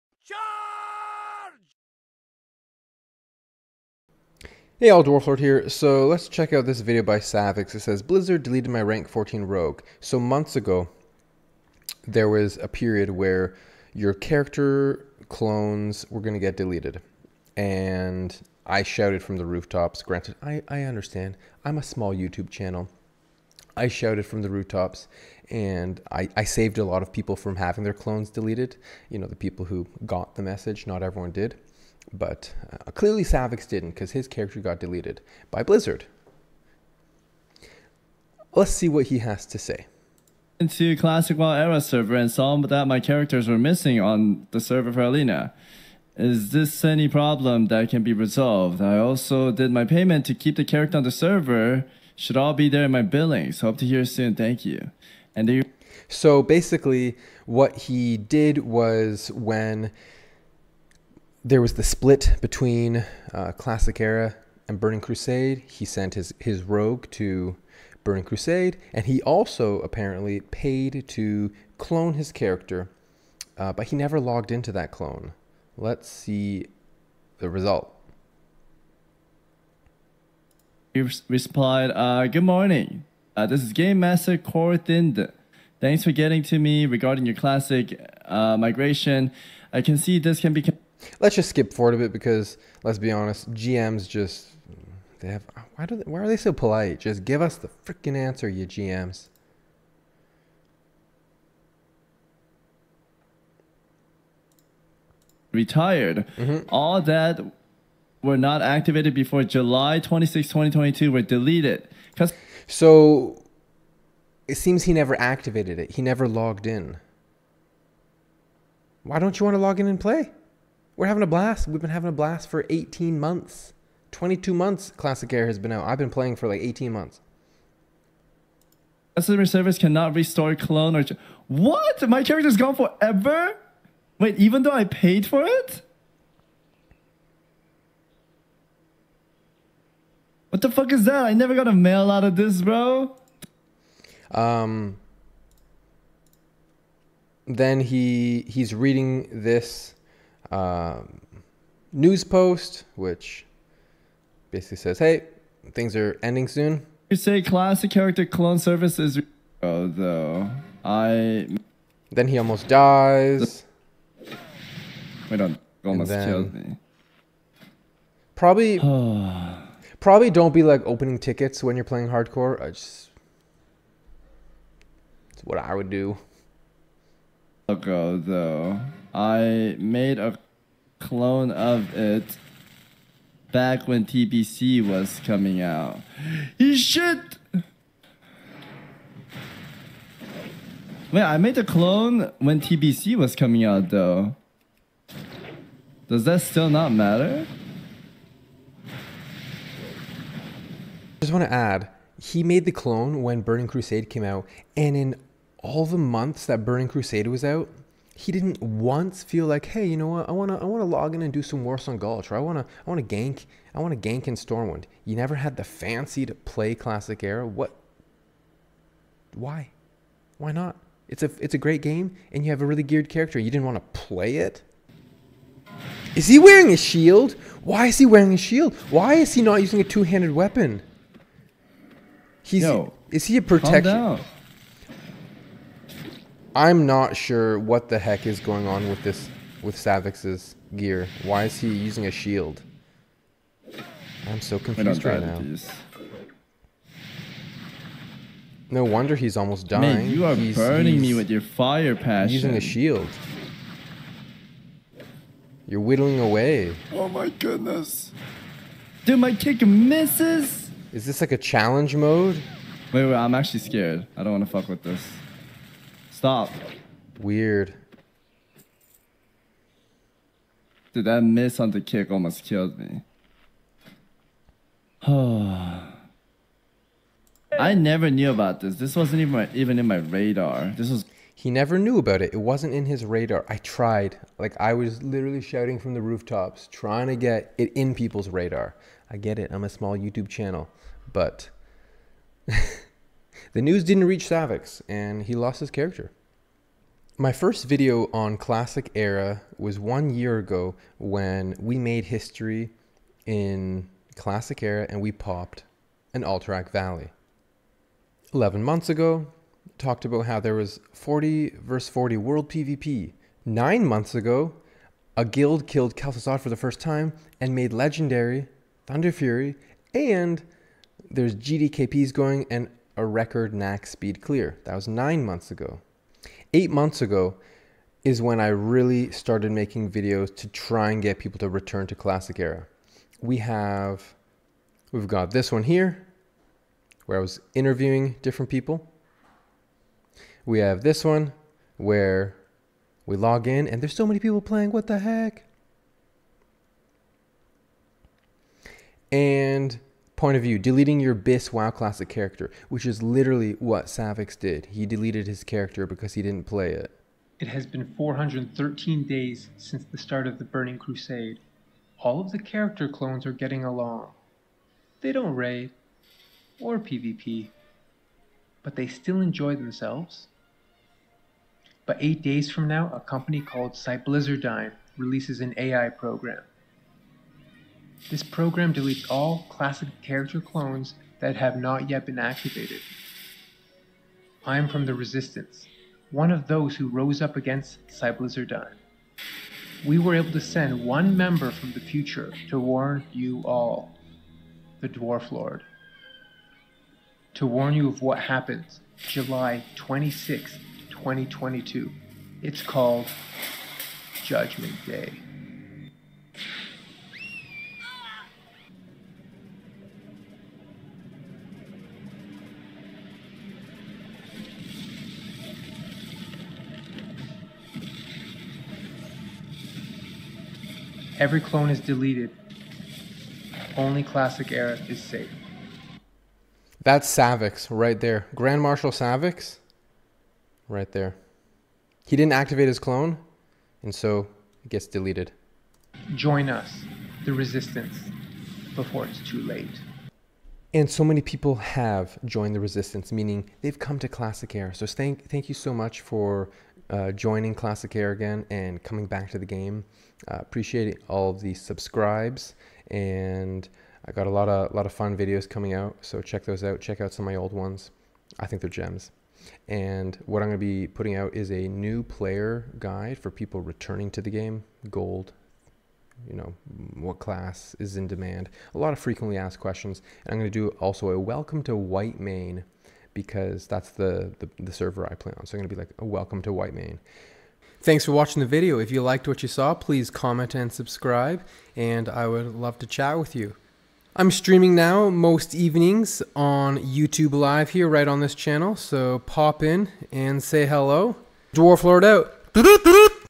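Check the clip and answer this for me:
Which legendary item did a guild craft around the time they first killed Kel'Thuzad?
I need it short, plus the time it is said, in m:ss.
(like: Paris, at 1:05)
Thunderfury, at 5:18.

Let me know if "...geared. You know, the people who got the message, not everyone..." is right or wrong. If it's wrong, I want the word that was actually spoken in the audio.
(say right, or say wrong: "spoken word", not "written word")
wrong: "deleted", not "geared".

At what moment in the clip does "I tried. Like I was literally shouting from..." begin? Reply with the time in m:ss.
4:43.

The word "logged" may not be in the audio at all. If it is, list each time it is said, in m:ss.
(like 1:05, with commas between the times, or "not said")
1:14, 1:56.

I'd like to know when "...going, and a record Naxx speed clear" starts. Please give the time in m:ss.
5:22.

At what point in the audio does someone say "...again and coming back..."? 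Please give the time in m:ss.
7:28.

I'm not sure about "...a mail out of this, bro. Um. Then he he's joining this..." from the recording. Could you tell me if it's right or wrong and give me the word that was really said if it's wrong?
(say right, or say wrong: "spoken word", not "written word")
wrong: "reading", not "joining".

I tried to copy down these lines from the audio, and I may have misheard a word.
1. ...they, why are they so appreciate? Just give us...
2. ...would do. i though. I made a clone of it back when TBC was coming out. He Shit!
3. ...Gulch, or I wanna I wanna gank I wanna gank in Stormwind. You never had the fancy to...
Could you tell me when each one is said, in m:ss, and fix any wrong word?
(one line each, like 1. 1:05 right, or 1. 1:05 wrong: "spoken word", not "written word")
1. 1:35 wrong: "polite", not "appreciate"
2. 2:55 right
3. 3:31 right.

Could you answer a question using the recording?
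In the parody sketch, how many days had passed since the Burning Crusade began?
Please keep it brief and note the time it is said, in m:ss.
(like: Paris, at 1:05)
413, at 5:57.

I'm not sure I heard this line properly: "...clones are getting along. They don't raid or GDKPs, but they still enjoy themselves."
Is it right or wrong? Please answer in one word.
wrong.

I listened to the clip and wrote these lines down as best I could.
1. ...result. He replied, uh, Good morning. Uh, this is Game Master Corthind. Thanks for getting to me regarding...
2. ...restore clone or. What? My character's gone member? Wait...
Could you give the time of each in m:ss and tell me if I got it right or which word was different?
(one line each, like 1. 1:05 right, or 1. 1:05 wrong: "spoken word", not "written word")
1. 1:17 right
2. 2:10 wrong: "forever", not "member".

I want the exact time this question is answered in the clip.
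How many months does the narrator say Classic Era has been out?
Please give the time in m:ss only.
2:04.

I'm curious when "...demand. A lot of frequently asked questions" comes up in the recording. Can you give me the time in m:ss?
7:48.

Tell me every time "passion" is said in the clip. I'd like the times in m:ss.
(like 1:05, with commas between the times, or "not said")
4:11.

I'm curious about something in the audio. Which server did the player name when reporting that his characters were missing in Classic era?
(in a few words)
Alina.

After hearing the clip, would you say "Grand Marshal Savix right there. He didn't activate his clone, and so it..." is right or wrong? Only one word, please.
right.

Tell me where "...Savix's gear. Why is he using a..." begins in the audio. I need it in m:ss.
3:59.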